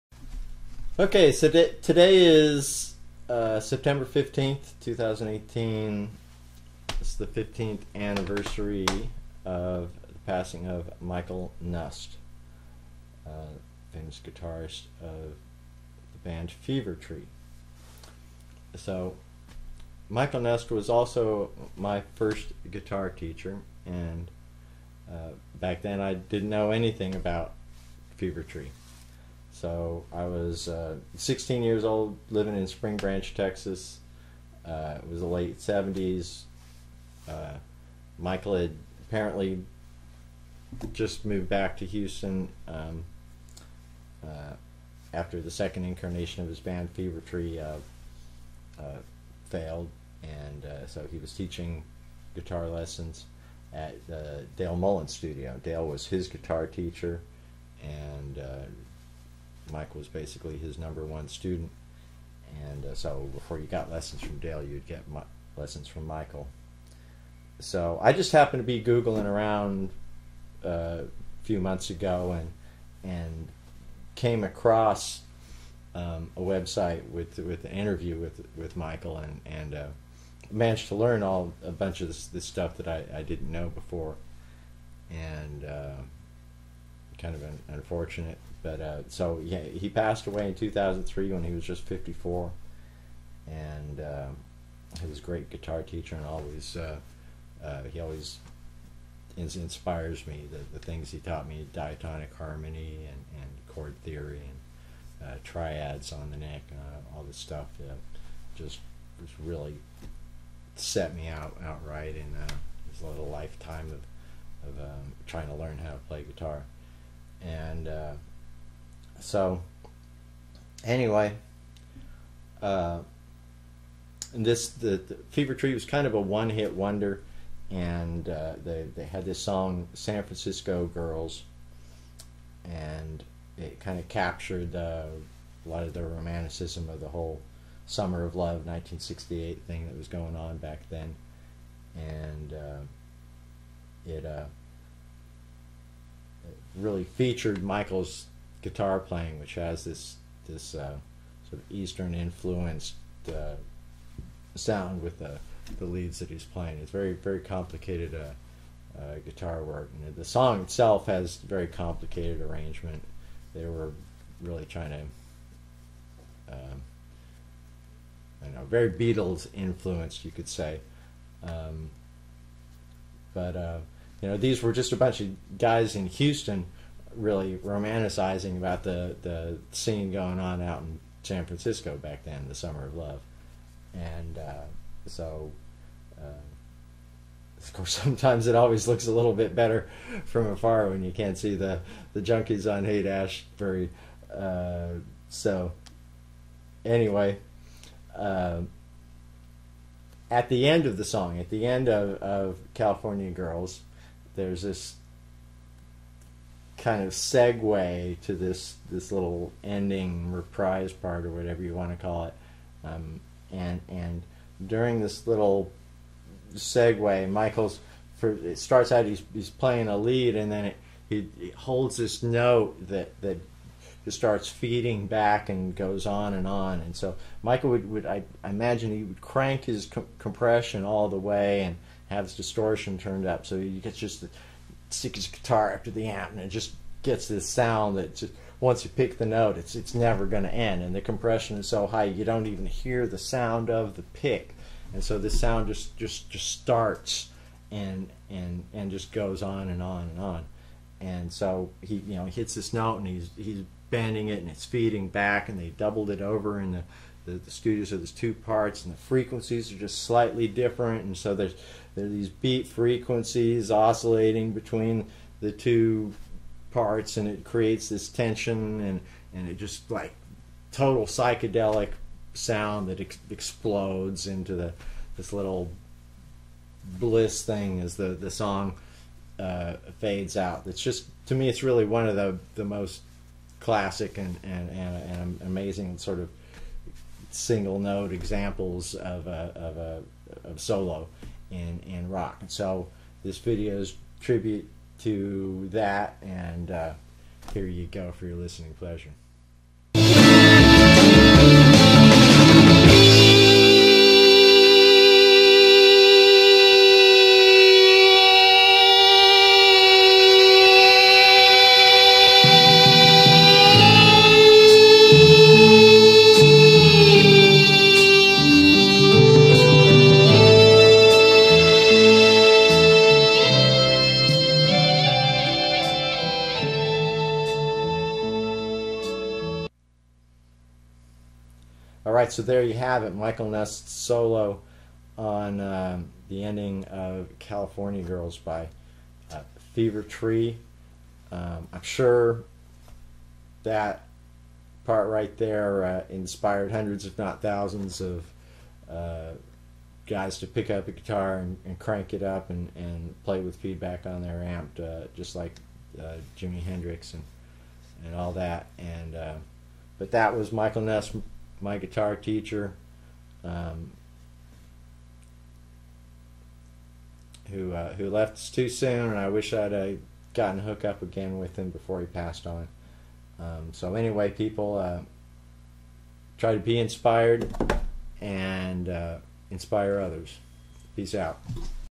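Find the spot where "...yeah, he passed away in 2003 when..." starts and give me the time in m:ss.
1:29.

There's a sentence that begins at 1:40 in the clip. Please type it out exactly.
The, the things he taught me: diatonic harmony and, and chord theory and uh, triads on the neck, all this stuff.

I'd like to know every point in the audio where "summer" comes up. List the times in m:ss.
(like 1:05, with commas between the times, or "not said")
2:17, 3:02.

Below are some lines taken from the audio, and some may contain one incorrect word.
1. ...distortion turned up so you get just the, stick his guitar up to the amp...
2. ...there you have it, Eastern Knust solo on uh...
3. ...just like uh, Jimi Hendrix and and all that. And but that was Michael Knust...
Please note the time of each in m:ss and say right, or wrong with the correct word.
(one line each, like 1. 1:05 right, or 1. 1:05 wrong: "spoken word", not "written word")
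1. 3:52 right
2. 5:32 wrong: "Michael", not "Eastern"
3. 5:55 right.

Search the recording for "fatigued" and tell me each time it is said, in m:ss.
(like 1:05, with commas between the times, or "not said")
not said.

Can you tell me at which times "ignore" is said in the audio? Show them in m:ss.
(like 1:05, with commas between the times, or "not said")
not said.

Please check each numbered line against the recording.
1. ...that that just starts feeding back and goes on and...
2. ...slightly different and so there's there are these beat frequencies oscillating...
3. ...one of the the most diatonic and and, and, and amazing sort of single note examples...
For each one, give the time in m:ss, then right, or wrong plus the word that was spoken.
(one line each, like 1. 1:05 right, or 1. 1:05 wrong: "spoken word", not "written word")
1. 3:42 right
2. 4:20 right
3. 4:41 wrong: "classic", not "diatonic".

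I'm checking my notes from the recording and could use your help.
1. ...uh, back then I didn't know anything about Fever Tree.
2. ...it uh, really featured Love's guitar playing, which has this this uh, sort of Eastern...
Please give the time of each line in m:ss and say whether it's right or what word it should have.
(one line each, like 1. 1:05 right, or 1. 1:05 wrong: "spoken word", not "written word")
1. 0:25 right
2. 2:24 wrong: "Michael", not "Love".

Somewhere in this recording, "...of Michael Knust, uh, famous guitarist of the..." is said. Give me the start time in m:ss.
0:10.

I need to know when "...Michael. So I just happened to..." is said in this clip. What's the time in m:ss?
1:06.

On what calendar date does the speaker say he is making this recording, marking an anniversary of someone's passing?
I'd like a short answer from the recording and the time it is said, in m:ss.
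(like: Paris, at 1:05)
September 15th, 2018, at 0:03.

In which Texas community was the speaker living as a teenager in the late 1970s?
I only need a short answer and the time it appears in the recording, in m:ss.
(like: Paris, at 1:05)
Spring Branch, at 0:32.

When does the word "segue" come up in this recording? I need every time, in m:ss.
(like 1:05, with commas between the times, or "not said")
3:27, 3:36.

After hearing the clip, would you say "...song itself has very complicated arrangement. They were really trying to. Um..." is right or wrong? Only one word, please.
right.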